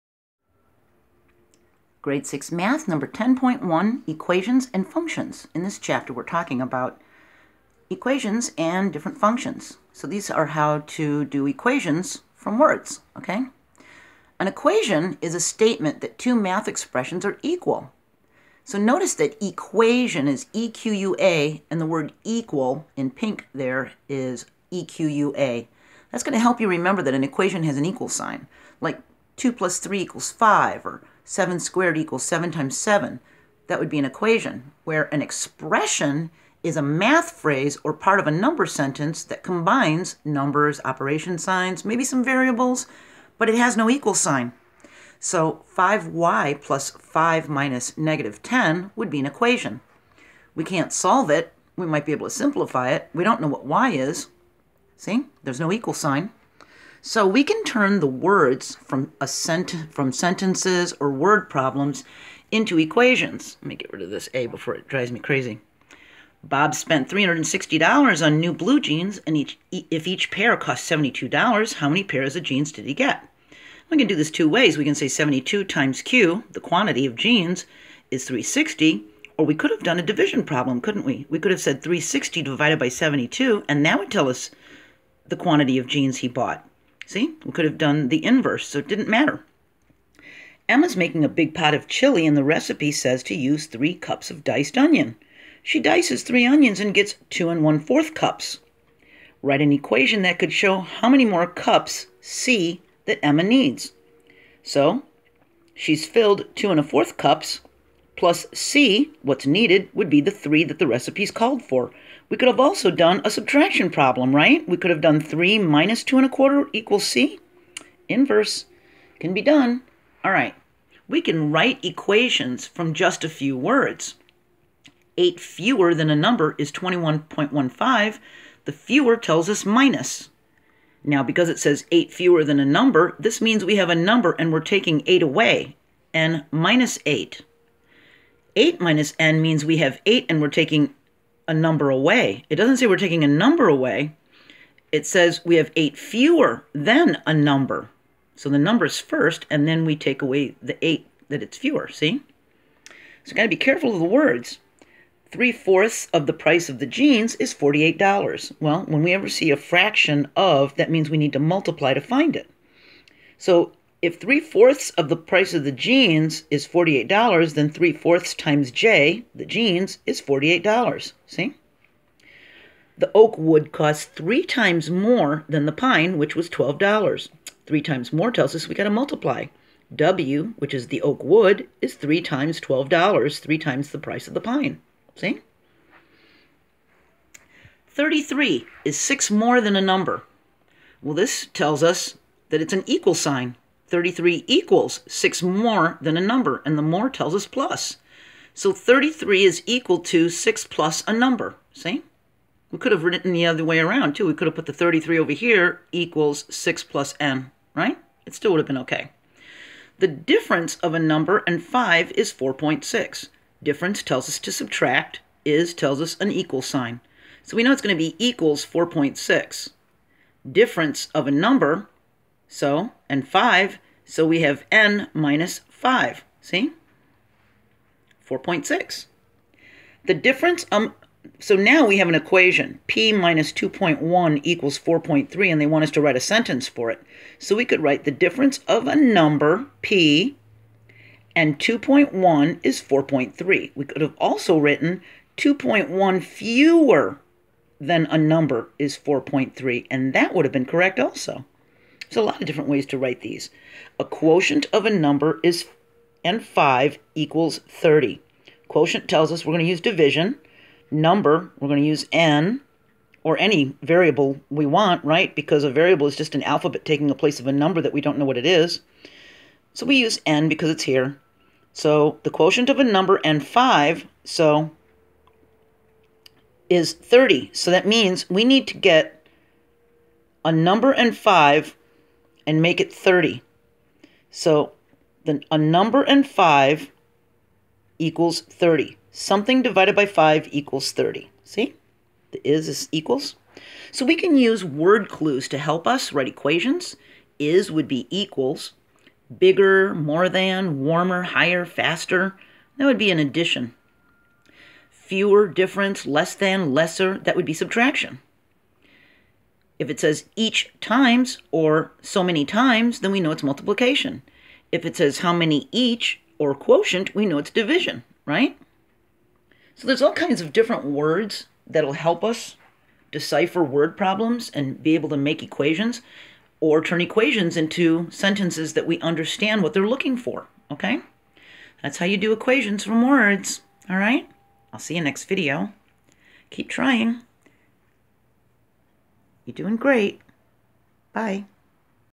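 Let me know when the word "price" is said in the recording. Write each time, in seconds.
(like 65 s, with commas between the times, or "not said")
156 s, 165 s, 183 s.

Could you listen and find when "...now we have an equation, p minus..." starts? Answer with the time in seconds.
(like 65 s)
231 s.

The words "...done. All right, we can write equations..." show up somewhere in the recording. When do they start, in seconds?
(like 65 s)
119 s.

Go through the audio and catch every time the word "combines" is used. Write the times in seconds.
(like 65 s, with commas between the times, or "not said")
39 s.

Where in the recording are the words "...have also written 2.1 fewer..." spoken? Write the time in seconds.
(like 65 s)
244 s.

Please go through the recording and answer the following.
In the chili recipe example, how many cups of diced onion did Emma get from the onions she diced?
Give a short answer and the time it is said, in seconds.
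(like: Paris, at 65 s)
2 1/4 cups, at 97 s.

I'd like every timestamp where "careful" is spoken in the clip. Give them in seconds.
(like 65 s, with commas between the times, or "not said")
153 s.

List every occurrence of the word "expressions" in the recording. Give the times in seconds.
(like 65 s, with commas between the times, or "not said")
16 s, 35 s.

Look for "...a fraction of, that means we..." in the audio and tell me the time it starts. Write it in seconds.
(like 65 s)
159 s.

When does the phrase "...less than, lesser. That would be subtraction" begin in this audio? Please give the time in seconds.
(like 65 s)
306 s.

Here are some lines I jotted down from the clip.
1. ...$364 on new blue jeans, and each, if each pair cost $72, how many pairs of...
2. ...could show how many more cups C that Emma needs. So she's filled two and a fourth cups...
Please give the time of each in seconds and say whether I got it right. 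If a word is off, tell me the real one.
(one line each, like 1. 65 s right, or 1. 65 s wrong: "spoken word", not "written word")
1. 67 s wrong: "360", not "364"
2. 100 s right.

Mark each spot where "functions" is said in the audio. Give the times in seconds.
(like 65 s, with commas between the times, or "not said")
4 s, 9 s.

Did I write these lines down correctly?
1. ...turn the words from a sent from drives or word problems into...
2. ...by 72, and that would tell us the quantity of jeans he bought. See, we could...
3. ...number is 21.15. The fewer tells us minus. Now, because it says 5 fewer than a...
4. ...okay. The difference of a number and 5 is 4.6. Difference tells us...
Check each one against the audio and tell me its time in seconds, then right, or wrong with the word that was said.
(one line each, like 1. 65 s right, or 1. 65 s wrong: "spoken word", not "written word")
1. 57 s wrong: "sentences", not "drives"
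2. 82 s right
3. 126 s wrong: "8", not "5"
4. 208 s right.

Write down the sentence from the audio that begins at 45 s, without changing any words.
So 5y plus 5 minus negative 10 would be an equation.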